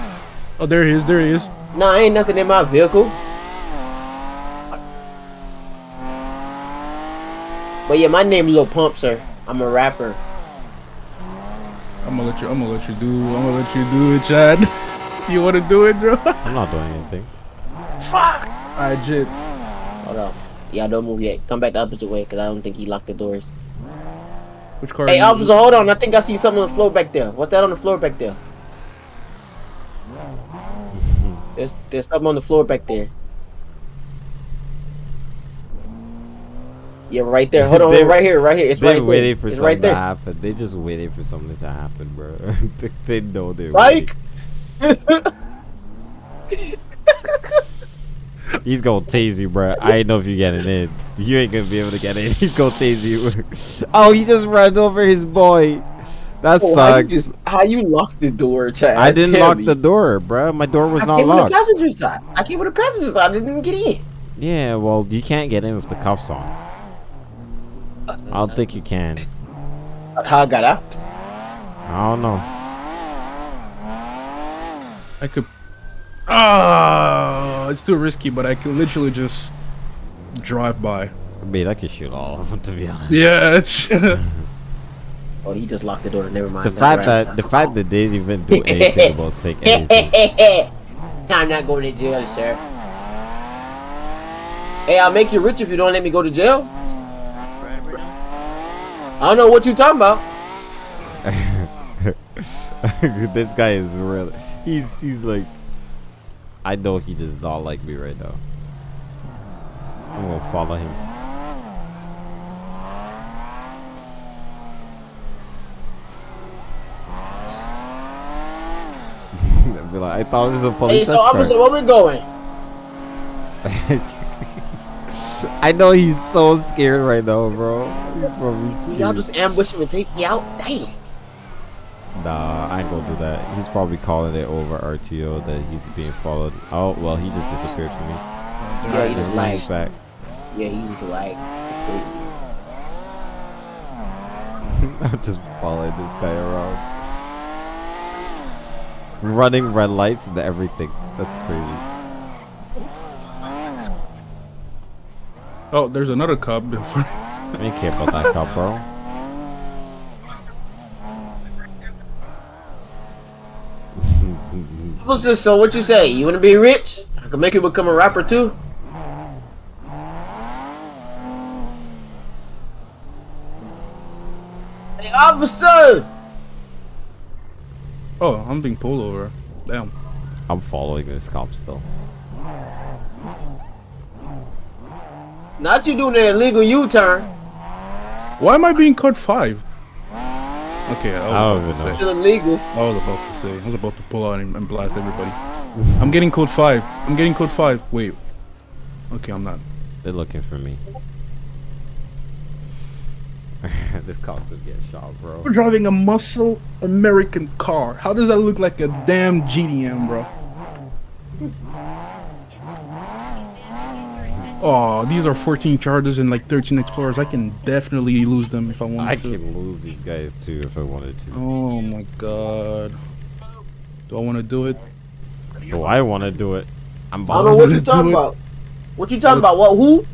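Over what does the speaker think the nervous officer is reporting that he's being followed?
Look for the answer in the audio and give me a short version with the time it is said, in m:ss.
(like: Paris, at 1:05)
RTO, at 2:14.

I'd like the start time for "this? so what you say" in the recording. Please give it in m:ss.
2:45.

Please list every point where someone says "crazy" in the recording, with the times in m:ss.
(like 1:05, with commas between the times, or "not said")
2:31.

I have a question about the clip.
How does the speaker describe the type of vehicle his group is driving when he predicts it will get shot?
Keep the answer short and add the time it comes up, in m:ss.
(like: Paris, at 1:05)
Muscle American car, at 3:25.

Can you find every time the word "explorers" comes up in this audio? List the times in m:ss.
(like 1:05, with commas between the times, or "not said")
3:36.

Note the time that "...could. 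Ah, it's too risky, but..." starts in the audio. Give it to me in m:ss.
1:15.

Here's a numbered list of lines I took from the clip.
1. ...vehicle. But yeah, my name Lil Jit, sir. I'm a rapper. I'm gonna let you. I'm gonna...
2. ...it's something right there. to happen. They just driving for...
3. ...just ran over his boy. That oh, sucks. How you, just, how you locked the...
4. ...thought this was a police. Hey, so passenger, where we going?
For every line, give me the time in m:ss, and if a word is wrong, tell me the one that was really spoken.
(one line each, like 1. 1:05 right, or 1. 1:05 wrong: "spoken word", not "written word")
1. 0:02 wrong: "Pump", not "Jit"
2. 0:39 wrong: "waiting", not "driving"
3. 0:54 right
4. 2:00 wrong: "officer", not "passenger".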